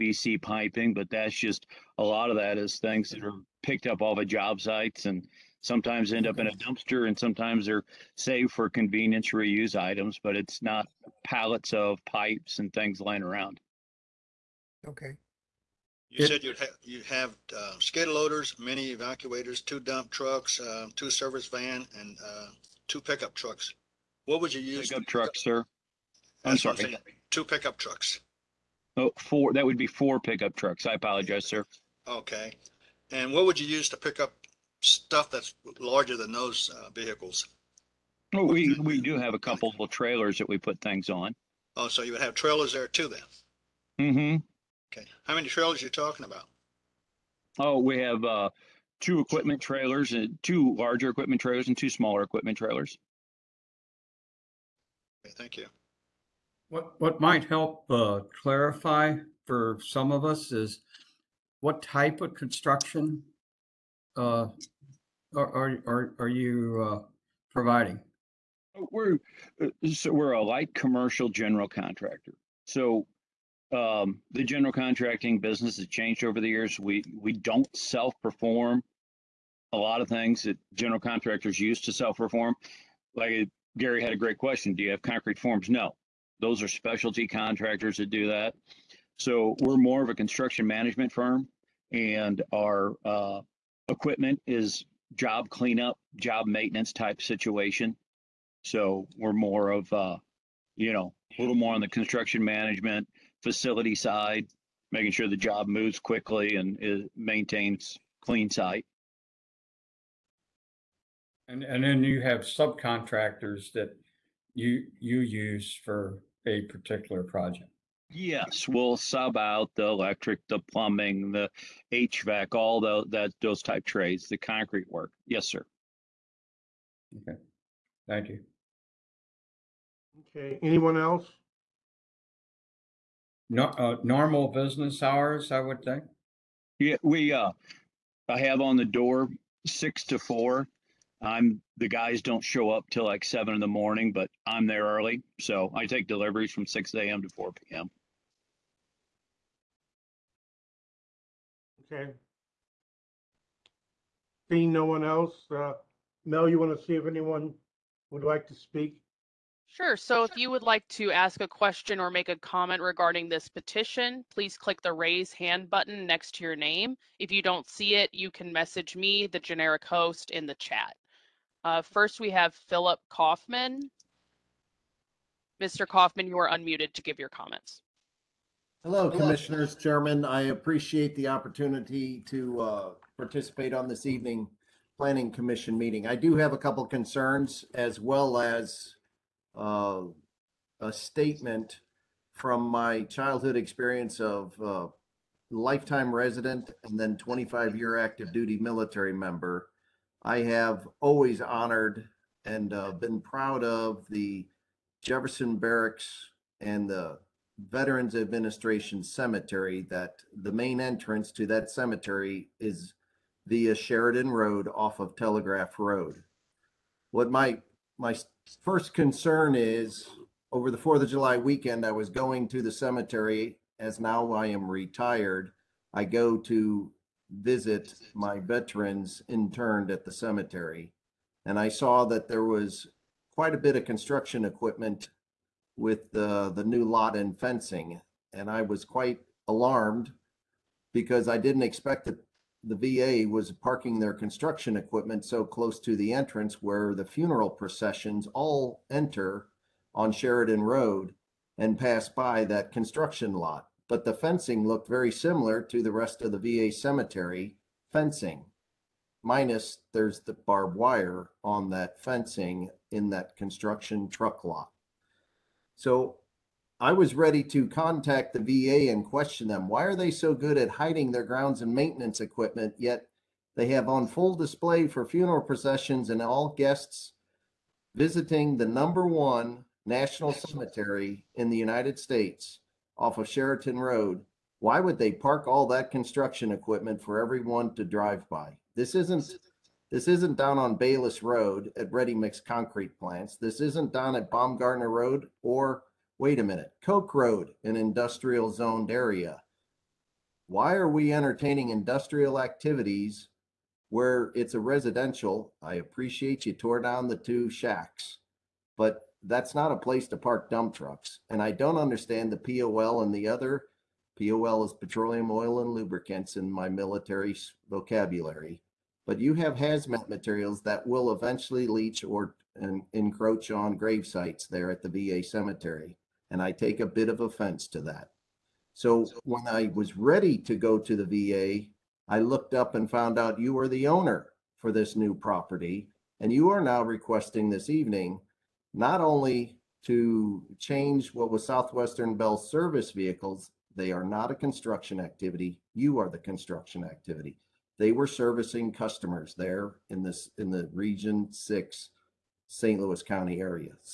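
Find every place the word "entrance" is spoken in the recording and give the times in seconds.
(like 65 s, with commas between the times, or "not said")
210 s, 246 s.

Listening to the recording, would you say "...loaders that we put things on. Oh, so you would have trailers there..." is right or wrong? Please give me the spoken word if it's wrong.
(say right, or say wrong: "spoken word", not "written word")
wrong: "trailers", not "loaders".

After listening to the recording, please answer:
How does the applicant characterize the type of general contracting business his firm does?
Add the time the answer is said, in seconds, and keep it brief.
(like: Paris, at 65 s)
light commercial, at 70 s.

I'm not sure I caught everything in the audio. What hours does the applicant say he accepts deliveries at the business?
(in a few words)
6 a.m. to 4 p.m.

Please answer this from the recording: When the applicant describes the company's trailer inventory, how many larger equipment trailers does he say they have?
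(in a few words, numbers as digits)
2.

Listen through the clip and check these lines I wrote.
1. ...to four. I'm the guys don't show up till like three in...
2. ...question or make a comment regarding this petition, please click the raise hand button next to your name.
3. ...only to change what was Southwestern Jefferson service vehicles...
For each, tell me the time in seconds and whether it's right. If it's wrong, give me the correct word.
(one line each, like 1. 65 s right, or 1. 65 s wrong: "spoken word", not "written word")
1. 140 s wrong: "seven", not "three"
2. 161 s right
3. 339 s wrong: "Bell", not "Jefferson".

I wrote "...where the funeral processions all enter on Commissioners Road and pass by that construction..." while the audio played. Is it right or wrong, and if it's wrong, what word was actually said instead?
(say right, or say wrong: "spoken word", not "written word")
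wrong: "Sheridan", not "Commissioners".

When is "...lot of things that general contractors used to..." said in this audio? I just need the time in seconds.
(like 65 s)
79 s.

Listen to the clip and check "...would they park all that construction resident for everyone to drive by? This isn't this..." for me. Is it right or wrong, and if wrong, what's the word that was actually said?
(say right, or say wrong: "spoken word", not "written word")
wrong: "equipment", not "resident".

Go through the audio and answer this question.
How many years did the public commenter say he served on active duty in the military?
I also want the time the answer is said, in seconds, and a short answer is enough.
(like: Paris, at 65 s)
25, at 197 s.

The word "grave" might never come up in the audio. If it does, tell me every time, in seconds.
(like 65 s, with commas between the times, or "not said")
323 s.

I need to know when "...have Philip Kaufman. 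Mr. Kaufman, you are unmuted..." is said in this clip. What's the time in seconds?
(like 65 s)
172 s.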